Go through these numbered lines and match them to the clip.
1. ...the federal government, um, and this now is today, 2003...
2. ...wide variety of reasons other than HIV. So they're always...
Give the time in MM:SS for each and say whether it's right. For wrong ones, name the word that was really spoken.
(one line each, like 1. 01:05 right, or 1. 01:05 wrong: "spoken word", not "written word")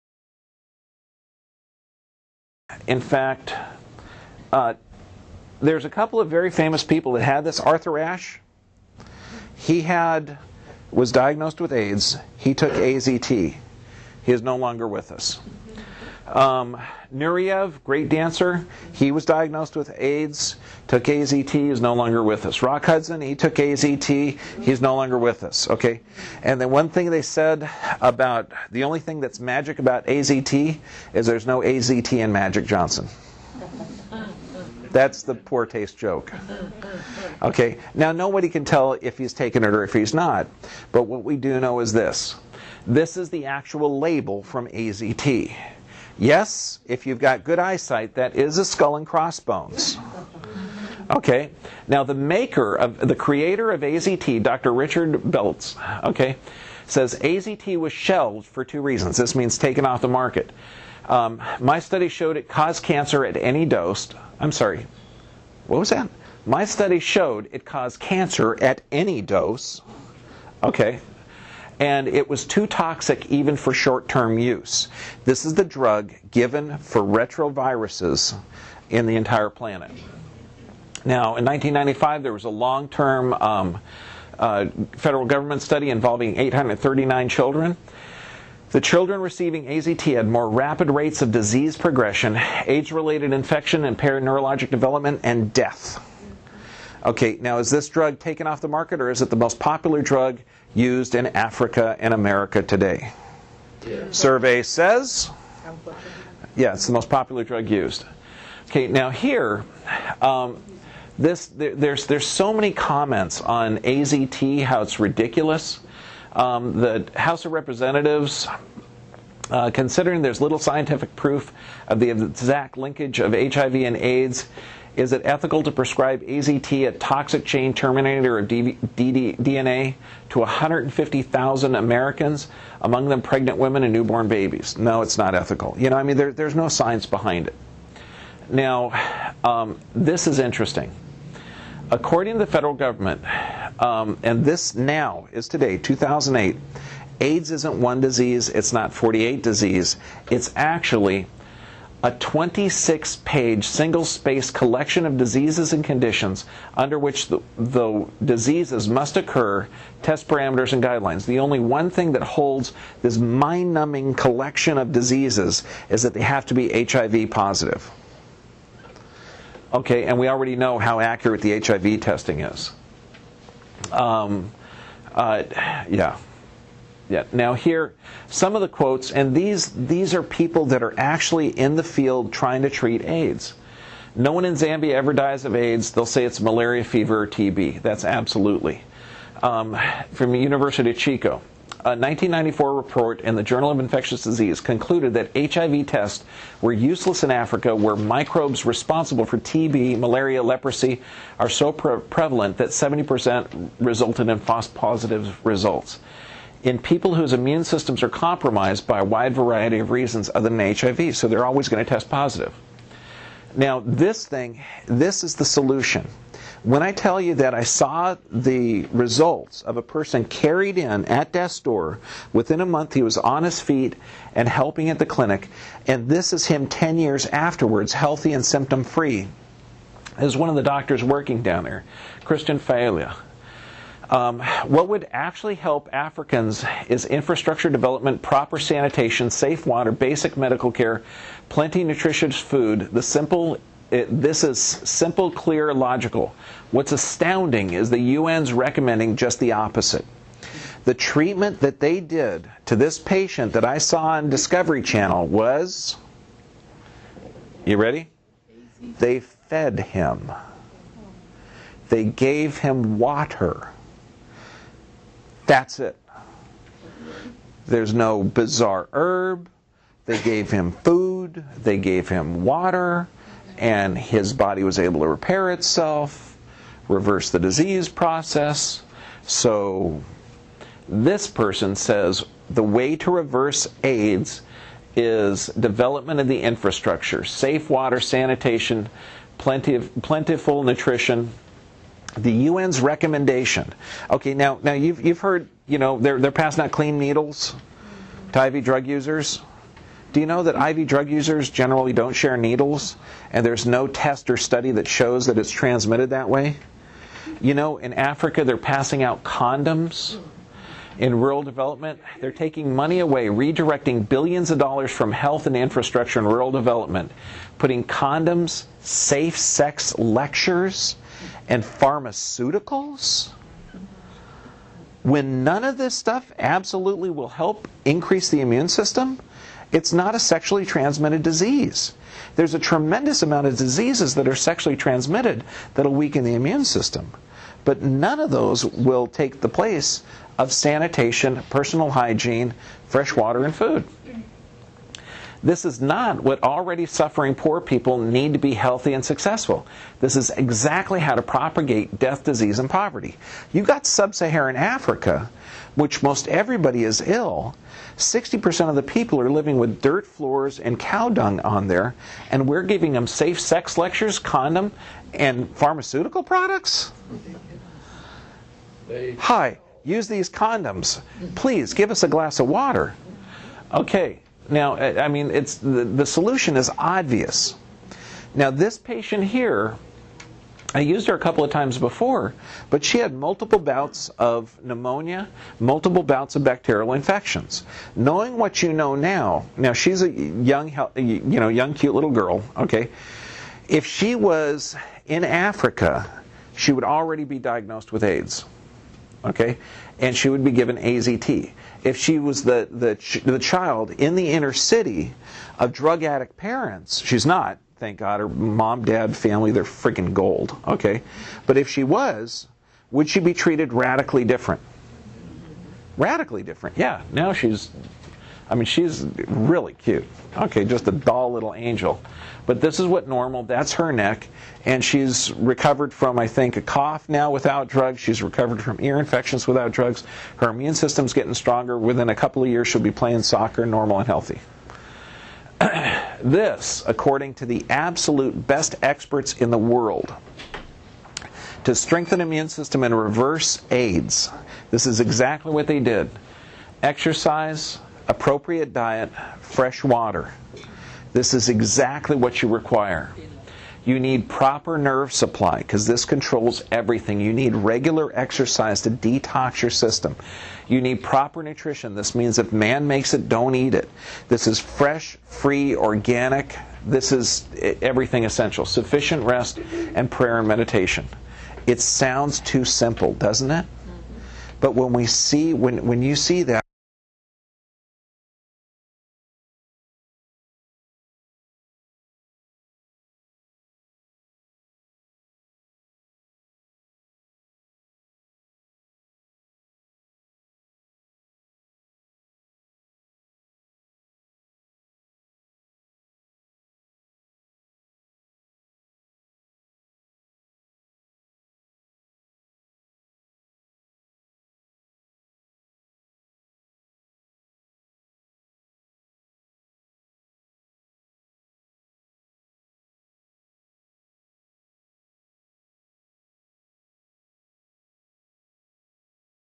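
1. 02:22 wrong: "2008", not "2003"
2. 03:29 right.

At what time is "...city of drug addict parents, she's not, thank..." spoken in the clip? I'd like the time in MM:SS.
06:44.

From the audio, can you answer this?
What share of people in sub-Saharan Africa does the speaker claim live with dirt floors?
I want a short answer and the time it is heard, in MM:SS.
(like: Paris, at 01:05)
60%, at 05:57.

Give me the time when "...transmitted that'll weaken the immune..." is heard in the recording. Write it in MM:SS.
05:34.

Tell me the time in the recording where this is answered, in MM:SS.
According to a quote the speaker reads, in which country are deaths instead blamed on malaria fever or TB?
03:04.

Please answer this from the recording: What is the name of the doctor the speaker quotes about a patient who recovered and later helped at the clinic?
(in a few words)
Christian Fiala.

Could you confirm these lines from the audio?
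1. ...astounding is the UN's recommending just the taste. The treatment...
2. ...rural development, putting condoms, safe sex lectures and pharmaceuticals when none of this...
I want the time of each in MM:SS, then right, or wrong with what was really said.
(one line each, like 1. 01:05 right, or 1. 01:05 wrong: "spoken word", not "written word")
1. 04:06 wrong: "opposite", not "taste"
2. 05:16 right.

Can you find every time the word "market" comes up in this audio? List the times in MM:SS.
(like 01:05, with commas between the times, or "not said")
01:00, 01:38.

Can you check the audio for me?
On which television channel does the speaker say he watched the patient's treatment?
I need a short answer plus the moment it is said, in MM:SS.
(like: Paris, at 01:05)
Discovery Channel, at 04:14.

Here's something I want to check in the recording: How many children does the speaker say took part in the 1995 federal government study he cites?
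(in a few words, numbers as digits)
839.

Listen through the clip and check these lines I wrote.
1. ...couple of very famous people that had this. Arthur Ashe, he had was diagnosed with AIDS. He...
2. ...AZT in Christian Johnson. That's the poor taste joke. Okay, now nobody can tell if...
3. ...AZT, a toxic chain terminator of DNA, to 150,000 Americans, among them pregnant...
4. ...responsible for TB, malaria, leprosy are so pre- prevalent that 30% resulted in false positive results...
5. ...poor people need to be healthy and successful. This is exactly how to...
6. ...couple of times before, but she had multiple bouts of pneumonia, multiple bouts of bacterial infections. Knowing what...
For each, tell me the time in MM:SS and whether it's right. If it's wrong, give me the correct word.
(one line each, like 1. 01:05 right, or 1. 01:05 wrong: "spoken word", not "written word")
1. 00:05 right
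2. 00:31 wrong: "Magic", not "Christian"
3. 02:06 right
4. 03:18 wrong: "70", not "30"
5. 05:47 right
6. 06:21 right.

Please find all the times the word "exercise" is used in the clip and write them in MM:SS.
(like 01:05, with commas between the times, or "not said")
07:26, 07:38.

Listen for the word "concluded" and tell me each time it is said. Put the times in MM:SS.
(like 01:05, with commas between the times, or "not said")
03:14.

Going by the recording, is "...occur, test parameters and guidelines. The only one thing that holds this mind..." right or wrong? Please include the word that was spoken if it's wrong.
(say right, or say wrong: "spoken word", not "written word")
right.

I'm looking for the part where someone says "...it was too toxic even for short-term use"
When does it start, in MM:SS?
01:12.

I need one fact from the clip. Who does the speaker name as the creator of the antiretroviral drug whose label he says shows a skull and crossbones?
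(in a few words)
Richard Beltz.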